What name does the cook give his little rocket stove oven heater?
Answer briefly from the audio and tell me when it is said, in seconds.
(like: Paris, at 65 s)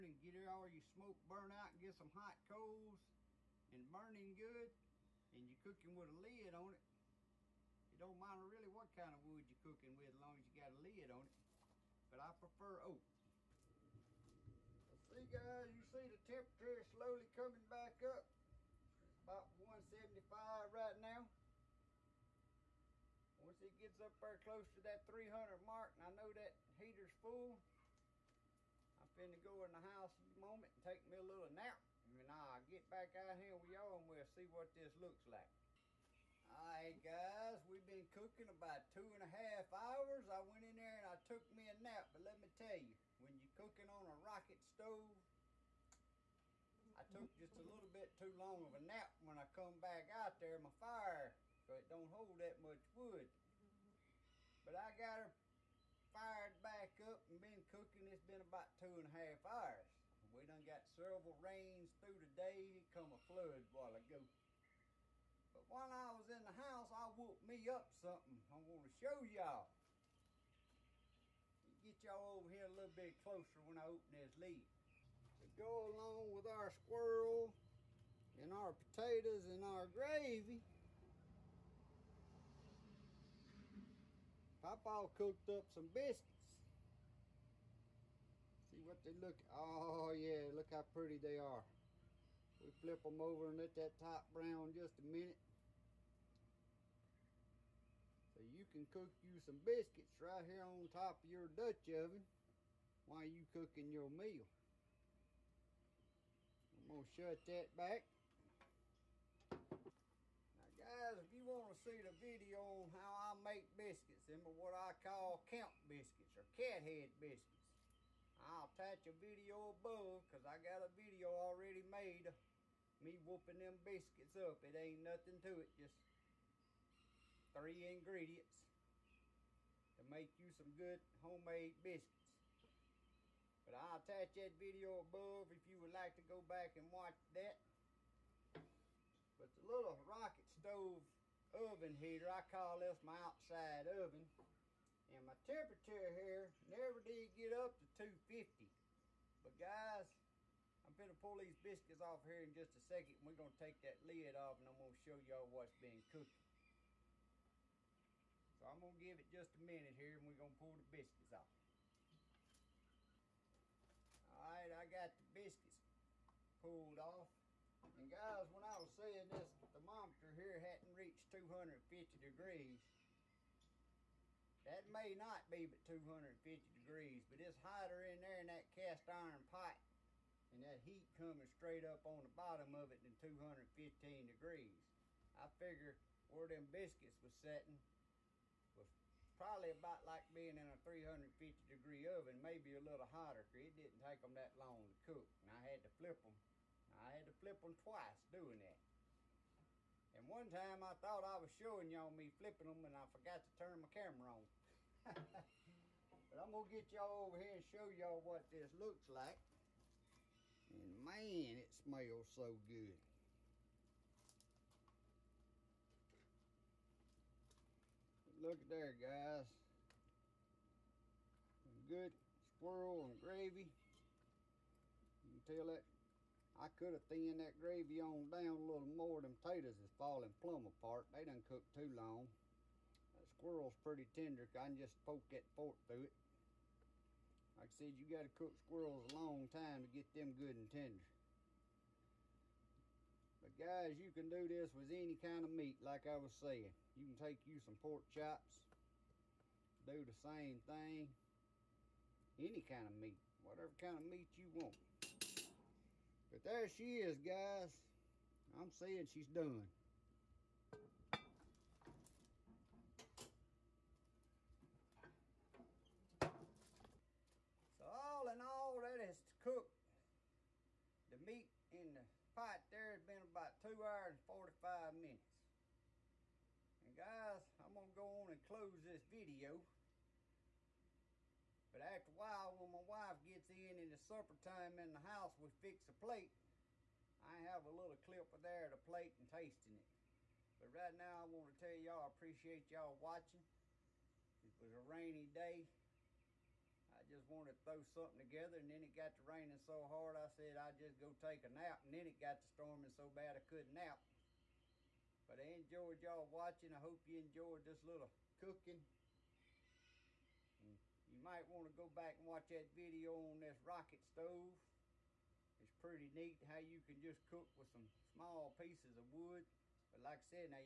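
My outside oven, at 143 s.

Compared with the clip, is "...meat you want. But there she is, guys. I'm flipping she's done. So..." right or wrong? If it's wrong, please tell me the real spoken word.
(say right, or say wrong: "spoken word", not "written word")
wrong: "saying", not "flipping".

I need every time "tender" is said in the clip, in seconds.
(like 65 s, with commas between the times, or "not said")
234 s, 240 s.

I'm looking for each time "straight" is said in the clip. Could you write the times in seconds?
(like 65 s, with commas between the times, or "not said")
181 s.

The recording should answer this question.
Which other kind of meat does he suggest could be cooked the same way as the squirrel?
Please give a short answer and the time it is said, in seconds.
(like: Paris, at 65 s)
Pork chops, at 247 s.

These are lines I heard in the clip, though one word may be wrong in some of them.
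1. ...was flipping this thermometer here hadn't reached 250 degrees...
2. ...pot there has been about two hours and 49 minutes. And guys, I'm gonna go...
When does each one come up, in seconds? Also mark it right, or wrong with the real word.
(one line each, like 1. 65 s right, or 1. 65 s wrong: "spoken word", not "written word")
1. 168 s wrong: "saying", not "flipping"
2. 272 s wrong: "45", not "49".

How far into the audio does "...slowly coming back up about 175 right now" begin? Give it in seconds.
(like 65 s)
16 s.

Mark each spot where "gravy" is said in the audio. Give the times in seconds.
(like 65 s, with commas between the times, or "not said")
79 s, 223 s, 227 s.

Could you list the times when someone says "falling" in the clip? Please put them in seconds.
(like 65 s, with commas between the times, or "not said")
229 s.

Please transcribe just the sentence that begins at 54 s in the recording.
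But I got her fired back up and been cooking.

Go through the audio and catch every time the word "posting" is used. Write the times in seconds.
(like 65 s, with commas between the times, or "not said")
not said.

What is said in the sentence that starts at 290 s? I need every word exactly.
But right now, I want to tell y'all I appreciate y'all watching.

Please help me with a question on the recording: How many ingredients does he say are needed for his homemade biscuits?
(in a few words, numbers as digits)
3.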